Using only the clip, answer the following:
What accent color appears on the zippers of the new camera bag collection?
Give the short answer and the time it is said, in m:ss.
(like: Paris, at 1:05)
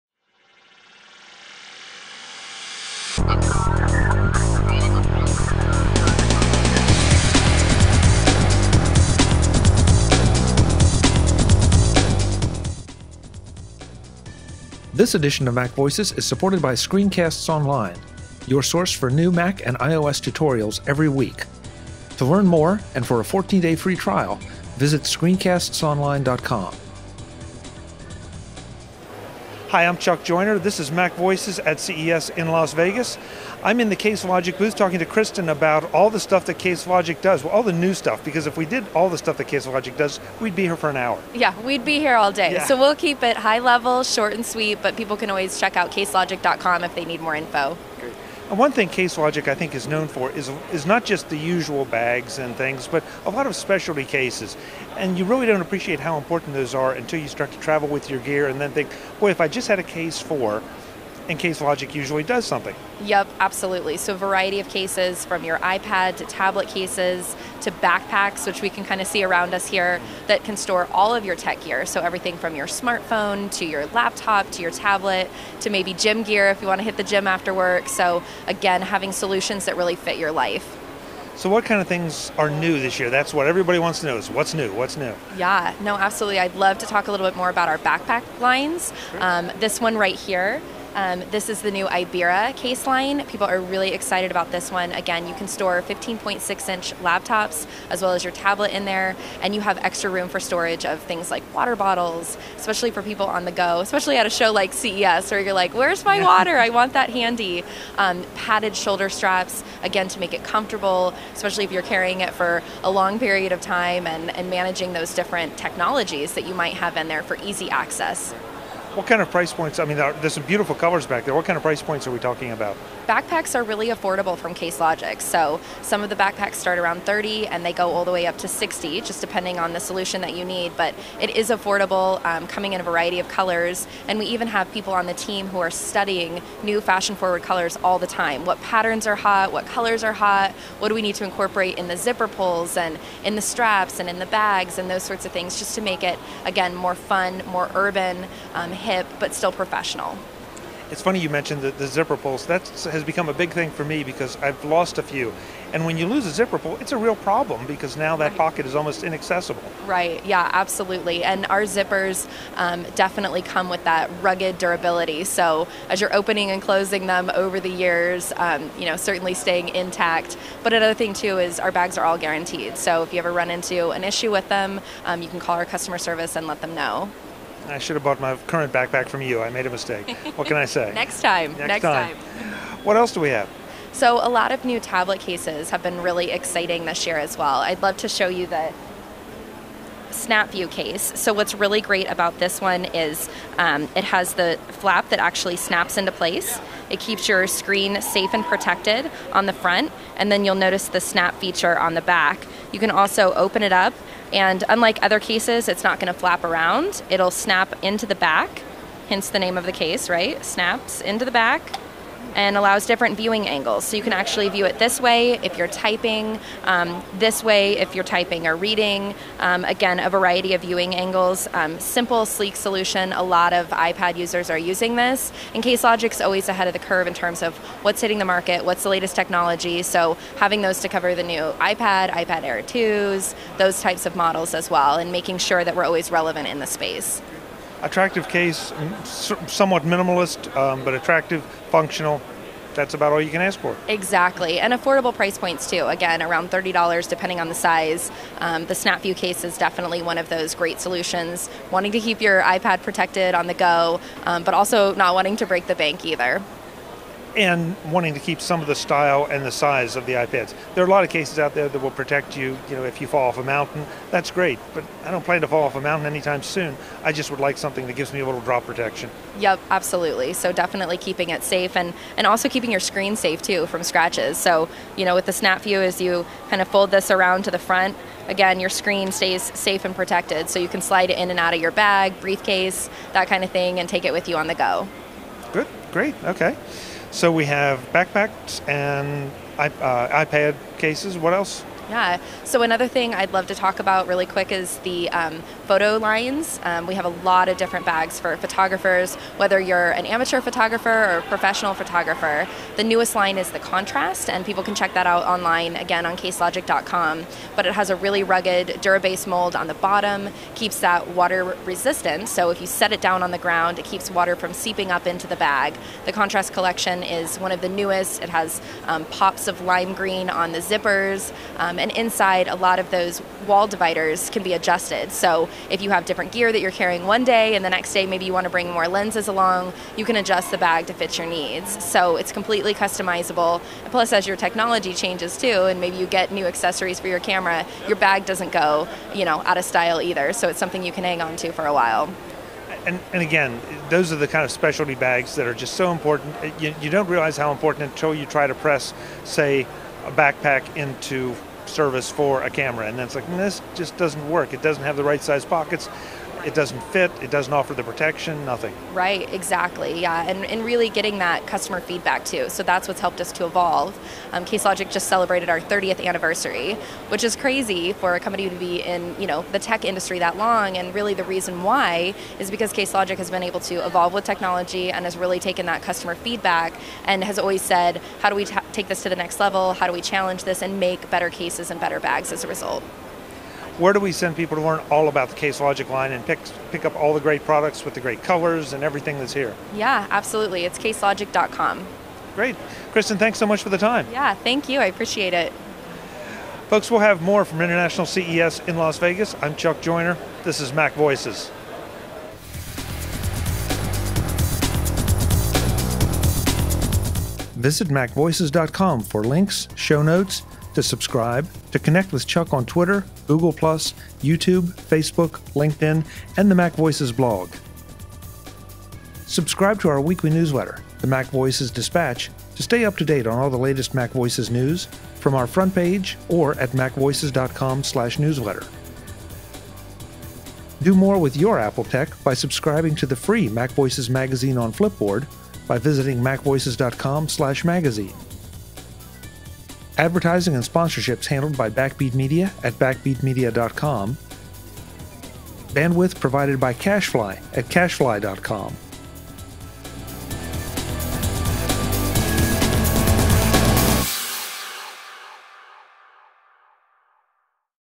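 lime green, at 5:19.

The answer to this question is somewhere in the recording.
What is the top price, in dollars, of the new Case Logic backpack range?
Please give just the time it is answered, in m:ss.
2:08.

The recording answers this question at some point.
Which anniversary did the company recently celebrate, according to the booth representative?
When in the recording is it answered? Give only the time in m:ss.
6:05.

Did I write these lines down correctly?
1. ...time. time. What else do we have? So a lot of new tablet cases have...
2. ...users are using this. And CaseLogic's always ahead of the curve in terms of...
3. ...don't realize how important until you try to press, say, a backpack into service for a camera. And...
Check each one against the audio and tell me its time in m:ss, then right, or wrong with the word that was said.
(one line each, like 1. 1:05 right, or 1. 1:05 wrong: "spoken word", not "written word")
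1. 3:01 right
2. 3:44 right
3. 5:46 right.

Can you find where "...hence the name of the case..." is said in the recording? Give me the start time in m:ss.
3:29.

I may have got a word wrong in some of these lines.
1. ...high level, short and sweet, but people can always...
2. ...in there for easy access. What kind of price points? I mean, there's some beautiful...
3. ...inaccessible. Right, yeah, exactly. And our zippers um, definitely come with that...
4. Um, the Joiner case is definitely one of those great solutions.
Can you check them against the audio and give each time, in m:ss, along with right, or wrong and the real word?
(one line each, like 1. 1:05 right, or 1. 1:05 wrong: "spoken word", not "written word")
1. 0:43 right
2. 1:56 right
3. 2:39 wrong: "absolutely", not "exactly"
4. 4:08 wrong: "SnapView", not "Joiner".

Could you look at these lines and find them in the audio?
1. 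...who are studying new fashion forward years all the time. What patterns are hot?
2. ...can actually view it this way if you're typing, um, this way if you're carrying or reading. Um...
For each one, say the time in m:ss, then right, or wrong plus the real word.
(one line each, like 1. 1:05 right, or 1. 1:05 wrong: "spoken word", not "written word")
1. 2:15 wrong: "colors", not "years"
2. 3:34 wrong: "typing", not "carrying".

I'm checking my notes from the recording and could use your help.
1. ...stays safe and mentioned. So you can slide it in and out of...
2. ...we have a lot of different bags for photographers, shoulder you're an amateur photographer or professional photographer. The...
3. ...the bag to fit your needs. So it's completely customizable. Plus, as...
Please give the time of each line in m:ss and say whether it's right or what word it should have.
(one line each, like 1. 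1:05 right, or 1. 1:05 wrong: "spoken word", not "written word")
1. 4:39 wrong: "protected", not "mentioned"
2. 4:56 wrong: "whether", not "shoulder"
3. 5:30 right.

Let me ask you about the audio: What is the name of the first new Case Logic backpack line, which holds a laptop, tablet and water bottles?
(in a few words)
Ibira.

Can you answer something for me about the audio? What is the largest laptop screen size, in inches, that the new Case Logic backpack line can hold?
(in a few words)
15.6.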